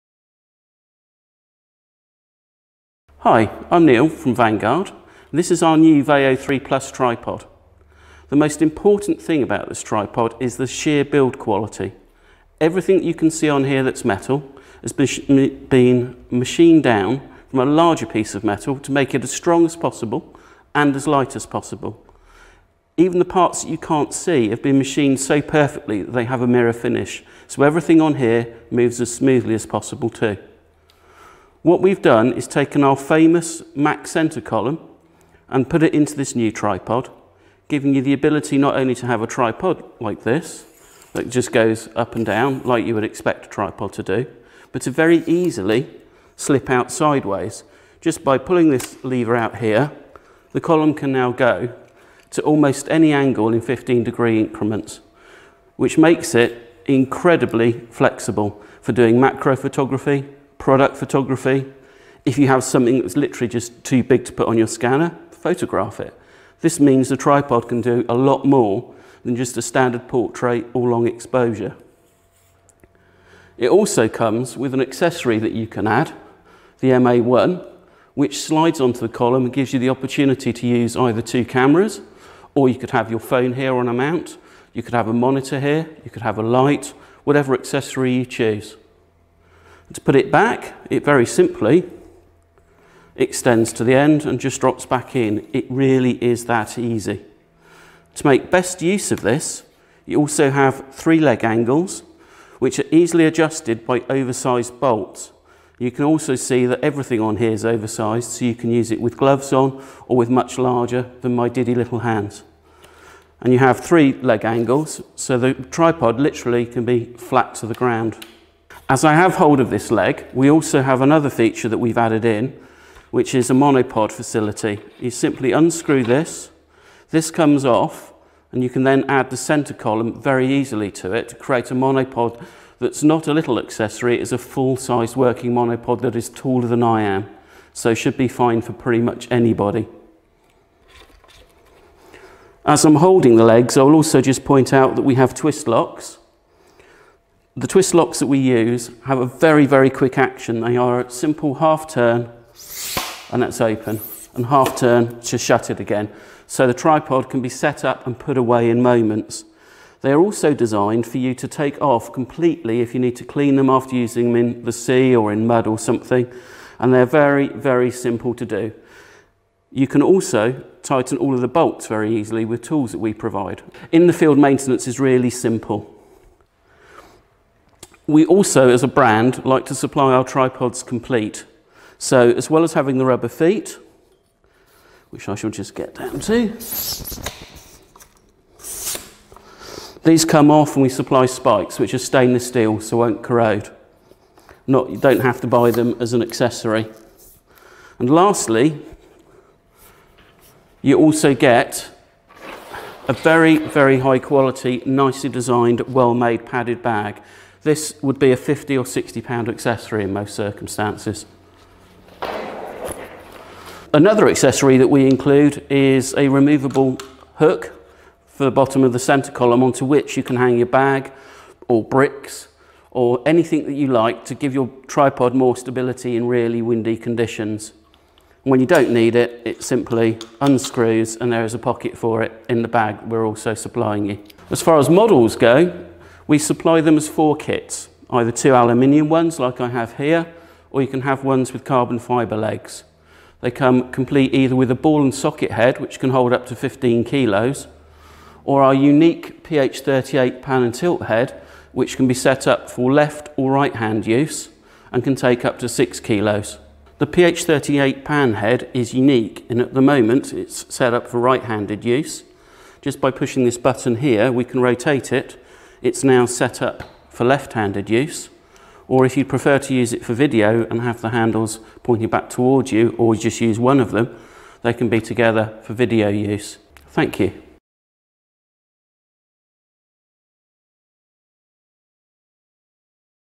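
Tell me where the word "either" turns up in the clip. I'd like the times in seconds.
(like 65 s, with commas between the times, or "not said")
80 s, 238 s, 244 s.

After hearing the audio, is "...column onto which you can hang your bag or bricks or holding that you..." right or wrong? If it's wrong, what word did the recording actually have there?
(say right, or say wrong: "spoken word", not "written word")
wrong: "anything", not "holding".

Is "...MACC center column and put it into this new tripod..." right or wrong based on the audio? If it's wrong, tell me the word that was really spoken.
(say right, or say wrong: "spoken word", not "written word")
right.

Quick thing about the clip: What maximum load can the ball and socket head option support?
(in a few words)
15 kilos.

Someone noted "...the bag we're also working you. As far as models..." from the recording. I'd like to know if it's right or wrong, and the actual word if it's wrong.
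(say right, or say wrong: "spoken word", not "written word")
wrong: "supplying", not "working".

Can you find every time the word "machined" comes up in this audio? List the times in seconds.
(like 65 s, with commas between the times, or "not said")
16 s, 24 s.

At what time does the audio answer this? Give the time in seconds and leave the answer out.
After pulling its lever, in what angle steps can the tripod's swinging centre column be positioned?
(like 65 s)
53 s.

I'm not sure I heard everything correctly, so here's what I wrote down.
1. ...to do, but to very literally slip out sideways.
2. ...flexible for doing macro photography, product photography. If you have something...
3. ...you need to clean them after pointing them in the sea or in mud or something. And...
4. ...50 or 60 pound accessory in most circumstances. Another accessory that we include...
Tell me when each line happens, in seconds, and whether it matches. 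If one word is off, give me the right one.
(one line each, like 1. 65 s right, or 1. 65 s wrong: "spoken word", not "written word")
1. 43 s wrong: "easily", not "literally"
2. 57 s right
3. 162 s wrong: "using", not "pointing"
4. 208 s right.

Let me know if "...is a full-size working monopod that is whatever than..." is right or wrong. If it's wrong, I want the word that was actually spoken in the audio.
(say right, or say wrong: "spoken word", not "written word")
wrong: "taller", not "whatever".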